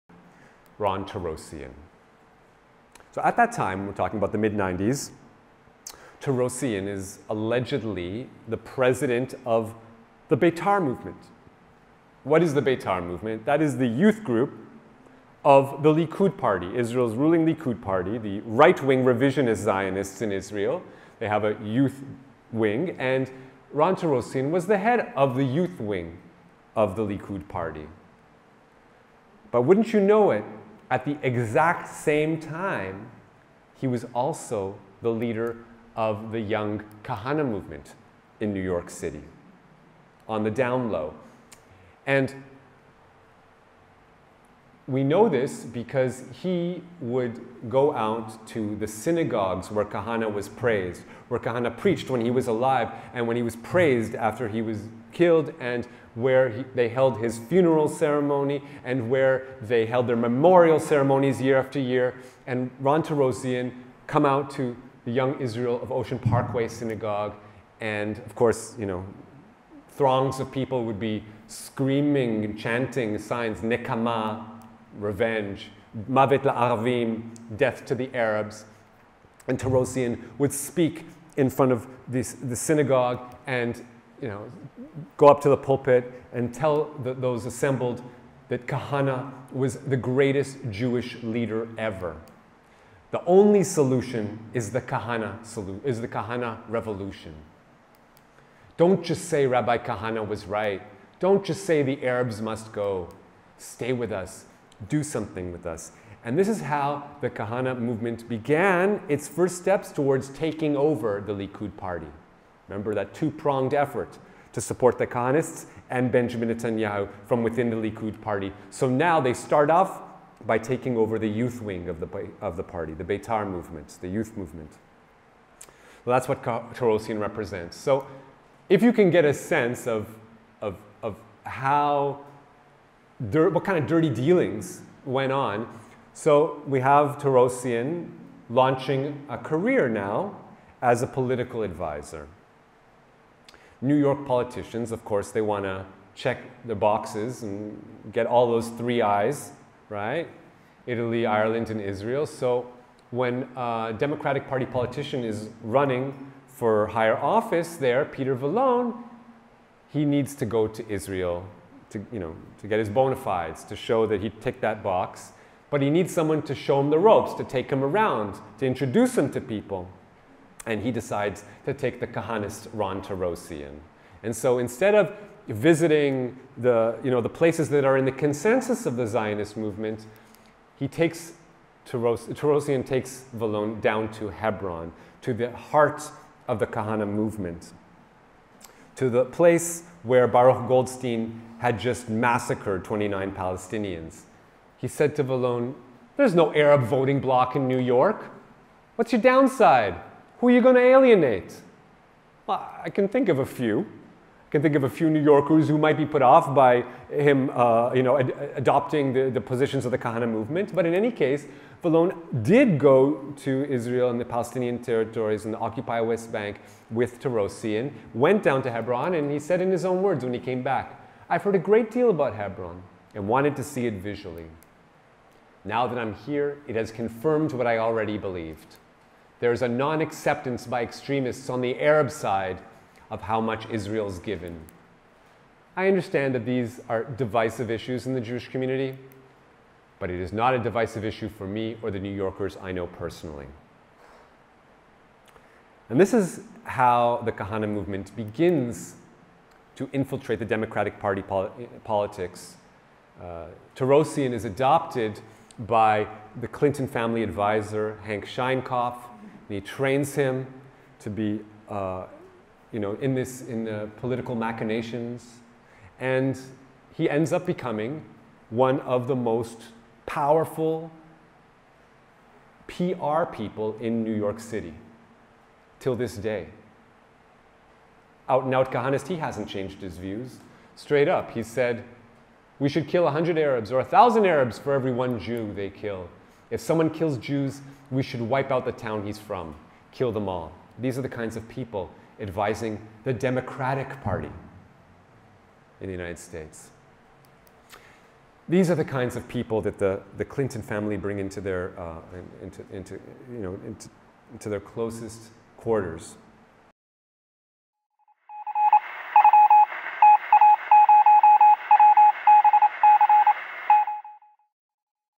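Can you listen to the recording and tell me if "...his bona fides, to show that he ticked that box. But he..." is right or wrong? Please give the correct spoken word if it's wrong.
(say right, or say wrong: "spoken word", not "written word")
right.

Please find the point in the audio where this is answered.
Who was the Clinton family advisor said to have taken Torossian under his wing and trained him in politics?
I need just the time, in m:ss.
4:18.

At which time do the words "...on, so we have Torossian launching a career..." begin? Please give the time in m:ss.
2:15.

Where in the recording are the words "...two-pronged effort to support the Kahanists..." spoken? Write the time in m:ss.
1:53.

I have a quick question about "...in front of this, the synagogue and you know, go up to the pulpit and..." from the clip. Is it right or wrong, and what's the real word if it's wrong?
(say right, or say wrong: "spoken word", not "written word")
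right.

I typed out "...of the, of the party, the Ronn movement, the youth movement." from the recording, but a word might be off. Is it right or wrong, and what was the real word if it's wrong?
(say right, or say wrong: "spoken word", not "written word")
wrong: "Beitar", not "Ronn".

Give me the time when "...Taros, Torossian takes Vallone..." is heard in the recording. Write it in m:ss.
3:01.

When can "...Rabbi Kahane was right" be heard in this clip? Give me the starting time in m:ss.
1:39.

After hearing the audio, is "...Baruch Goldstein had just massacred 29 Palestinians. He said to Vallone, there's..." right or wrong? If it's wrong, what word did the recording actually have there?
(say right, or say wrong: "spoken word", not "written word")
right.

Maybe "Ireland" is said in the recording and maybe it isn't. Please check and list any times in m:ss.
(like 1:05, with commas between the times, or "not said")
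2:31.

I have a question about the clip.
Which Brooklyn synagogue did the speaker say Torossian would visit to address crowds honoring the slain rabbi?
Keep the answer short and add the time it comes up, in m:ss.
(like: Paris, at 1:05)
Young Israel of Ocean Parkway, at 1:05.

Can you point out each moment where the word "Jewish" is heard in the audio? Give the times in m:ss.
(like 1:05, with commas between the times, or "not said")
1:30, 3:58.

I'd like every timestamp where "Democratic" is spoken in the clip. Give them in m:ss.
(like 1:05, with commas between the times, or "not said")
2:33, 4:10, 4:53.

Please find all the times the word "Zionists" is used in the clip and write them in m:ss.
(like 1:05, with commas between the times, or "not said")
0:19, 2:59.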